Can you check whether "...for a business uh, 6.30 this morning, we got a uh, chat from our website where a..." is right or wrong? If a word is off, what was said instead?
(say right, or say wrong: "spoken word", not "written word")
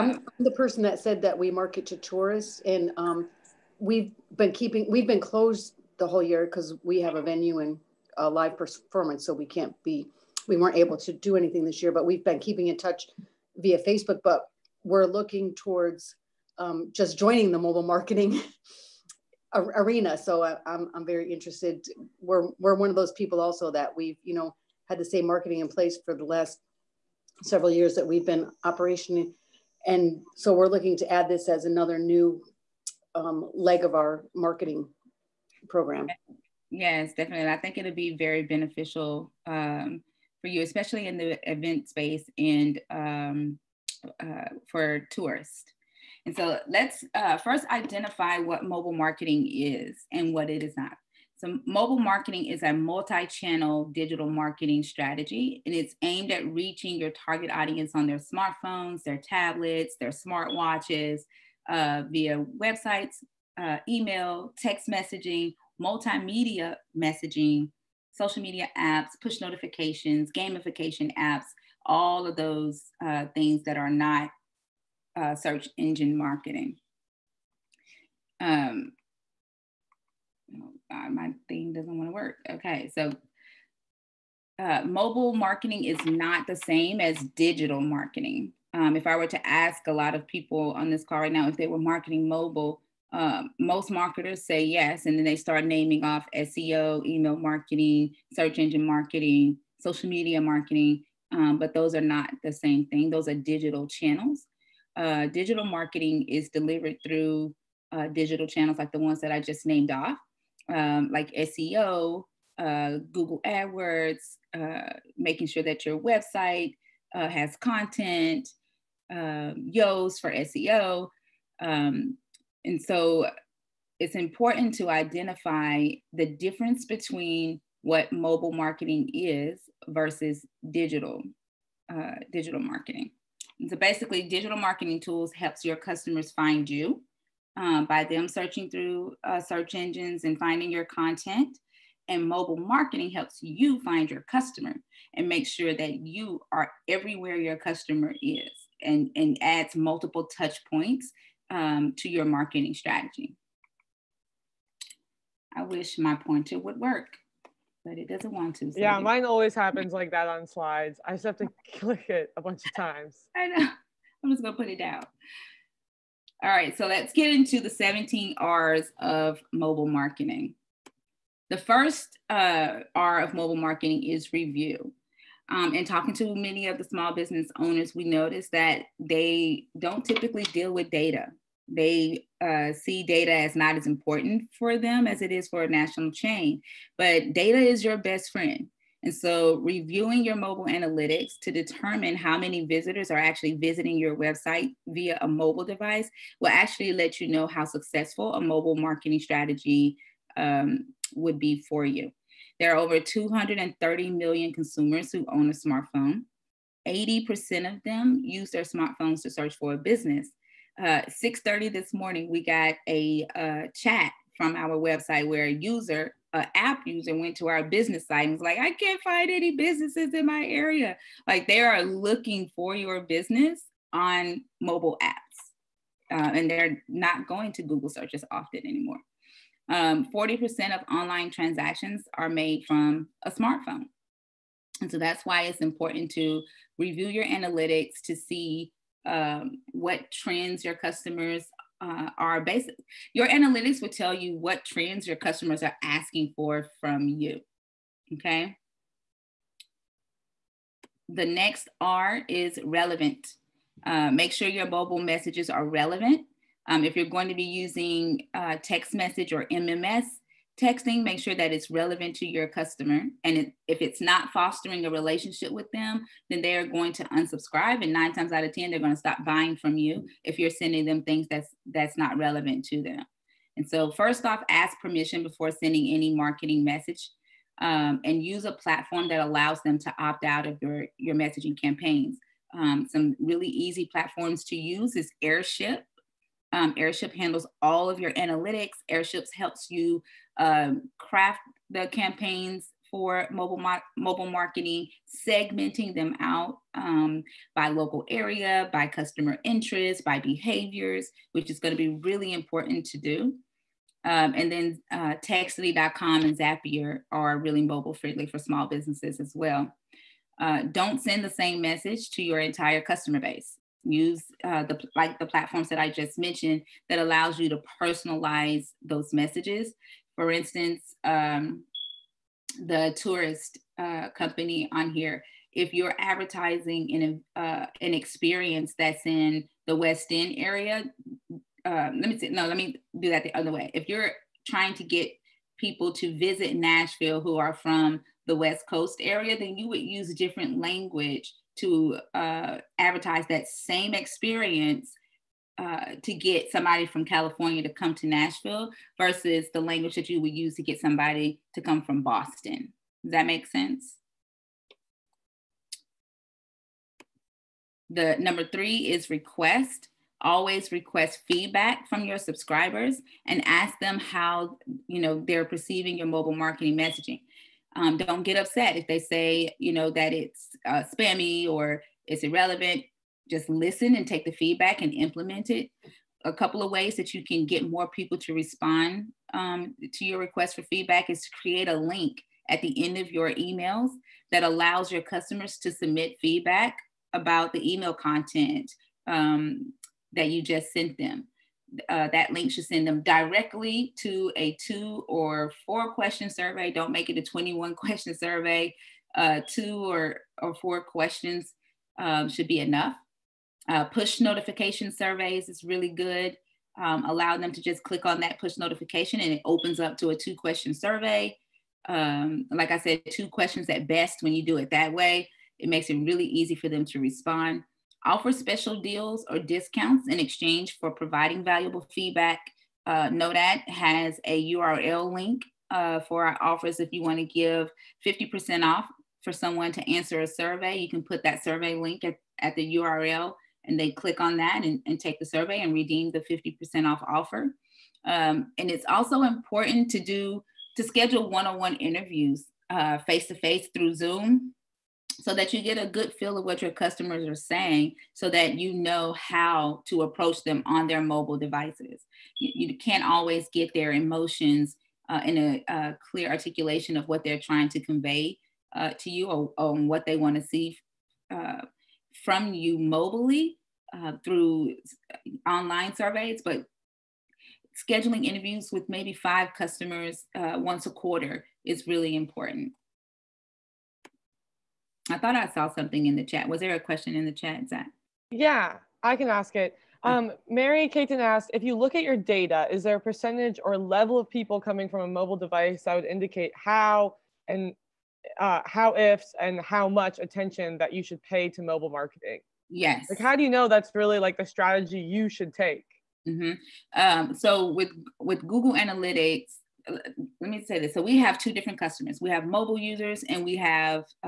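right.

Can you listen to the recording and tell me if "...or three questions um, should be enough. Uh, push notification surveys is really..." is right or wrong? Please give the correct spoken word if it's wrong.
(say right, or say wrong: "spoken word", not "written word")
wrong: "four", not "three".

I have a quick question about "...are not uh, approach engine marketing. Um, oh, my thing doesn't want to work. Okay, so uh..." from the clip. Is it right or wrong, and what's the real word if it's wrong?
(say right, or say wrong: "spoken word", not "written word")
wrong: "search", not "approach".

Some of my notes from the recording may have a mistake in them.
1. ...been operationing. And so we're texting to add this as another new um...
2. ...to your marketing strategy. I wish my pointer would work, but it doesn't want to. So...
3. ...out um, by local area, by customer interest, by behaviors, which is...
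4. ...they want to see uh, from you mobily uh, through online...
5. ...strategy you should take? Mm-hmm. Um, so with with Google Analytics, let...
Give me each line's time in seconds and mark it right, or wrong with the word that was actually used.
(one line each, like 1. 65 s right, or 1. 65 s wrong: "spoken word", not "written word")
1. 28 s wrong: "looking", not "texting"
2. 151 s right
3. 296 s right
4. 460 s right
5. 494 s right.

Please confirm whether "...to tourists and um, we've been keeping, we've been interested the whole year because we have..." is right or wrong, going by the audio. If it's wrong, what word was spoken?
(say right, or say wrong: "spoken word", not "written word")
wrong: "closed", not "interested".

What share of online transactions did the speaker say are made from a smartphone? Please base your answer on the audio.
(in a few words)
40%.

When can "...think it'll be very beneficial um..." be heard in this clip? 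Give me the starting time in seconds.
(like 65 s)
37 s.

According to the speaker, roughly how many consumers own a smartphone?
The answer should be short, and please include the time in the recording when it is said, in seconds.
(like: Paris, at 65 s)
230 million, at 202 s.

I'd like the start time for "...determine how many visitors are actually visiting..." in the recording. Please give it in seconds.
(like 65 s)
191 s.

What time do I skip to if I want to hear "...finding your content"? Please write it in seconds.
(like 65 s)
140 s.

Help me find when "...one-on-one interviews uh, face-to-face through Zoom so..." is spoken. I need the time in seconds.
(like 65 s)
441 s.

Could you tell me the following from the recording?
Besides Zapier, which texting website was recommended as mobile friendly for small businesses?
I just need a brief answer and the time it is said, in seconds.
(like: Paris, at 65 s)
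Textedly.com, at 305 s.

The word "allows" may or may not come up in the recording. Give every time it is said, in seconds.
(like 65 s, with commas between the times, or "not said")
279 s, 316 s, 384 s, 407 s.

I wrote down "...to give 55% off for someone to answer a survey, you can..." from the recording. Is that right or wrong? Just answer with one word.
wrong.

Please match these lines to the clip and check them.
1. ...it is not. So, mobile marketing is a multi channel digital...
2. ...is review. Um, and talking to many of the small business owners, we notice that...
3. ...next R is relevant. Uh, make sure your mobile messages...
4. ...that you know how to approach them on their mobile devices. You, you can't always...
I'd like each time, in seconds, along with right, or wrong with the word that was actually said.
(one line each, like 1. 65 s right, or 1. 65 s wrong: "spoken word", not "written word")
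1. 50 s right
2. 174 s right
3. 251 s right
4. 448 s right.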